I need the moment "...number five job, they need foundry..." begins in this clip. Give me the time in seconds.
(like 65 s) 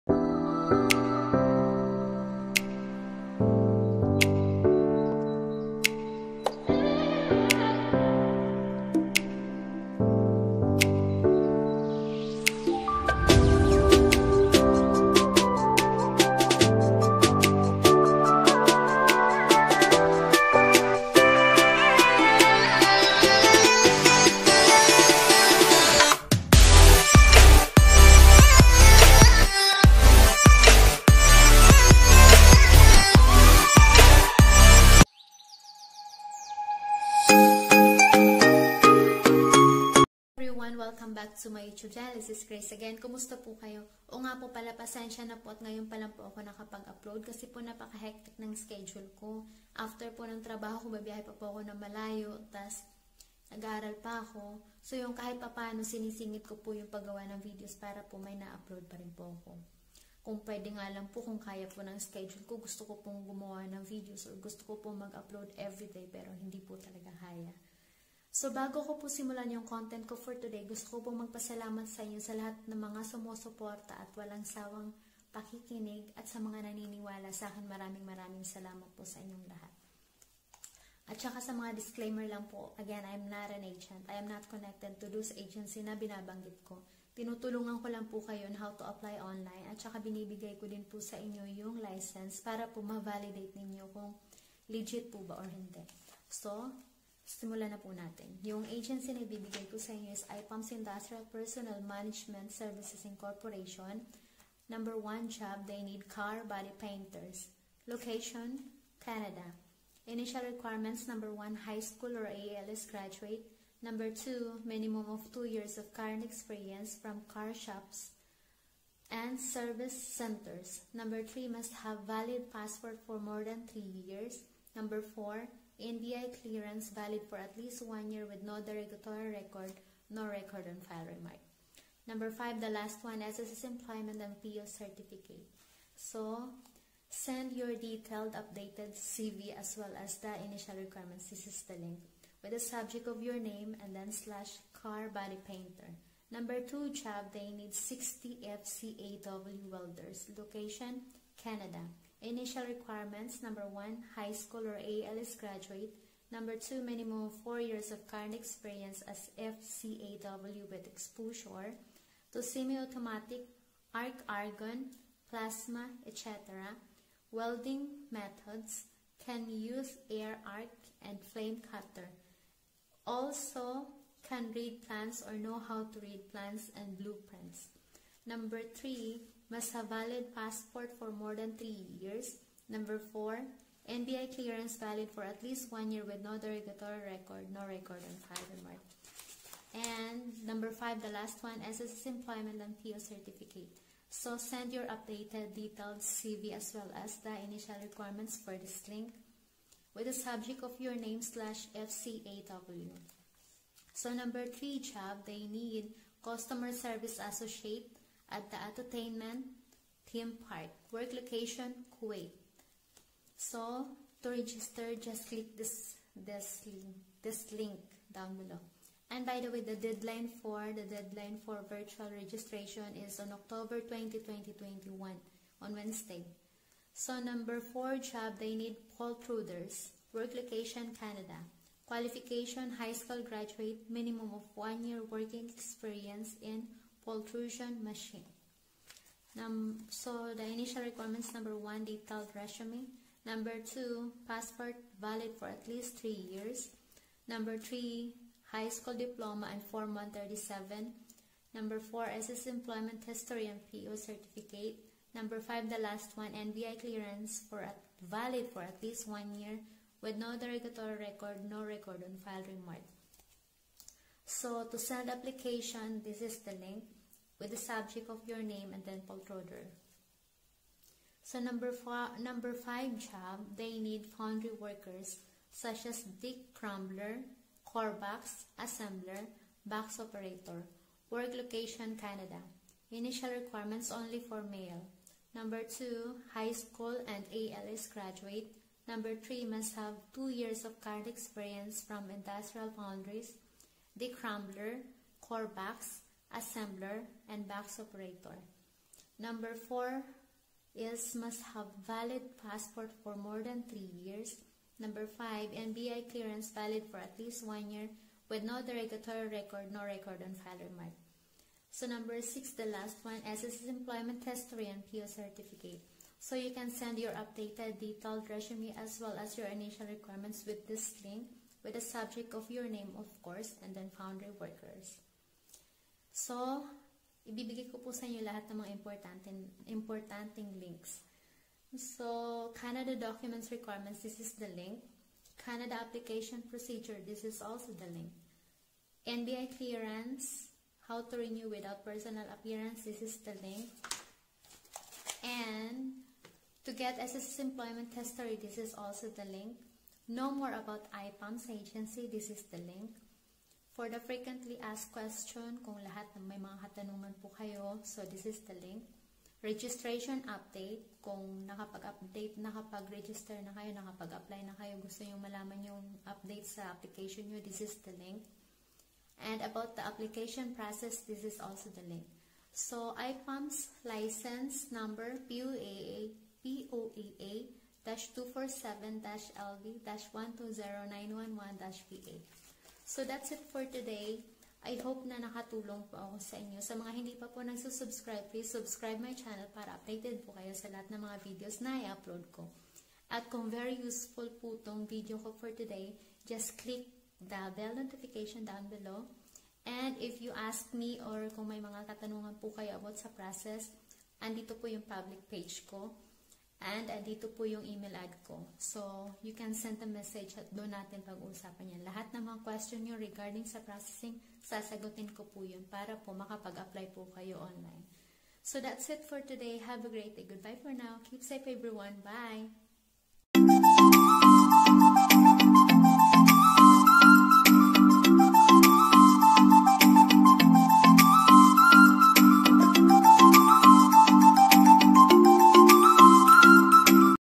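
272 s.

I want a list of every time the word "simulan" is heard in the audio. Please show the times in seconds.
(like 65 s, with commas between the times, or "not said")
69 s, 97 s.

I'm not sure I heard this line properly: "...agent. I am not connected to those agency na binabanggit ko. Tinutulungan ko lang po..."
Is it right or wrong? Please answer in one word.
right.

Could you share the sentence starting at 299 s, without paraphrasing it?
Number 4 is must have valid passport for more than 3 years.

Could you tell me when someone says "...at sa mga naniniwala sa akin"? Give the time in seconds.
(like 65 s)
76 s.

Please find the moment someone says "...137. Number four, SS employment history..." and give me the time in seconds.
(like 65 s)
249 s.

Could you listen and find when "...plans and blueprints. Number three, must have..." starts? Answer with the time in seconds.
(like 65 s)
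176 s.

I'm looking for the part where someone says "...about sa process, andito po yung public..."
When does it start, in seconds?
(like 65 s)
402 s.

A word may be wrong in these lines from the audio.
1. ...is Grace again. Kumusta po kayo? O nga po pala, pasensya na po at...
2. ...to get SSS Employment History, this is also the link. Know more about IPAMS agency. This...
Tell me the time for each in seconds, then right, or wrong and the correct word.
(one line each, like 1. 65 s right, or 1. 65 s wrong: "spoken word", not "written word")
1. 42 s right
2. 346 s right.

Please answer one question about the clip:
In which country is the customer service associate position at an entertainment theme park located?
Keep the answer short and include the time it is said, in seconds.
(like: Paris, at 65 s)
Kuwait, at 212 s.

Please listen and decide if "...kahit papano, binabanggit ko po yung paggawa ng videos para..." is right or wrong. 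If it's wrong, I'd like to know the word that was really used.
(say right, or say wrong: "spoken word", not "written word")
wrong: "sinisingit", not "binabanggit".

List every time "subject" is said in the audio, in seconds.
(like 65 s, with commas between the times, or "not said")
142 s, 200 s, 267 s, 321 s.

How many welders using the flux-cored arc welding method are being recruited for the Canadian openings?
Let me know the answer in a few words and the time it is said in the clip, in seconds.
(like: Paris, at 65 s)
60, at 147 s.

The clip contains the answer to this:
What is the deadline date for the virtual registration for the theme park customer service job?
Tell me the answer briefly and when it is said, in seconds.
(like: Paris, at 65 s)
October 20, 2021, at 223 s.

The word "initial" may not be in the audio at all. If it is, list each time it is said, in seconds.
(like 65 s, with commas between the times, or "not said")
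110 s, 140 s, 152 s, 197 s, 240 s, 282 s, 319 s.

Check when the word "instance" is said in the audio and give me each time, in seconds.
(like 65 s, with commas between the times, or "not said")
not said.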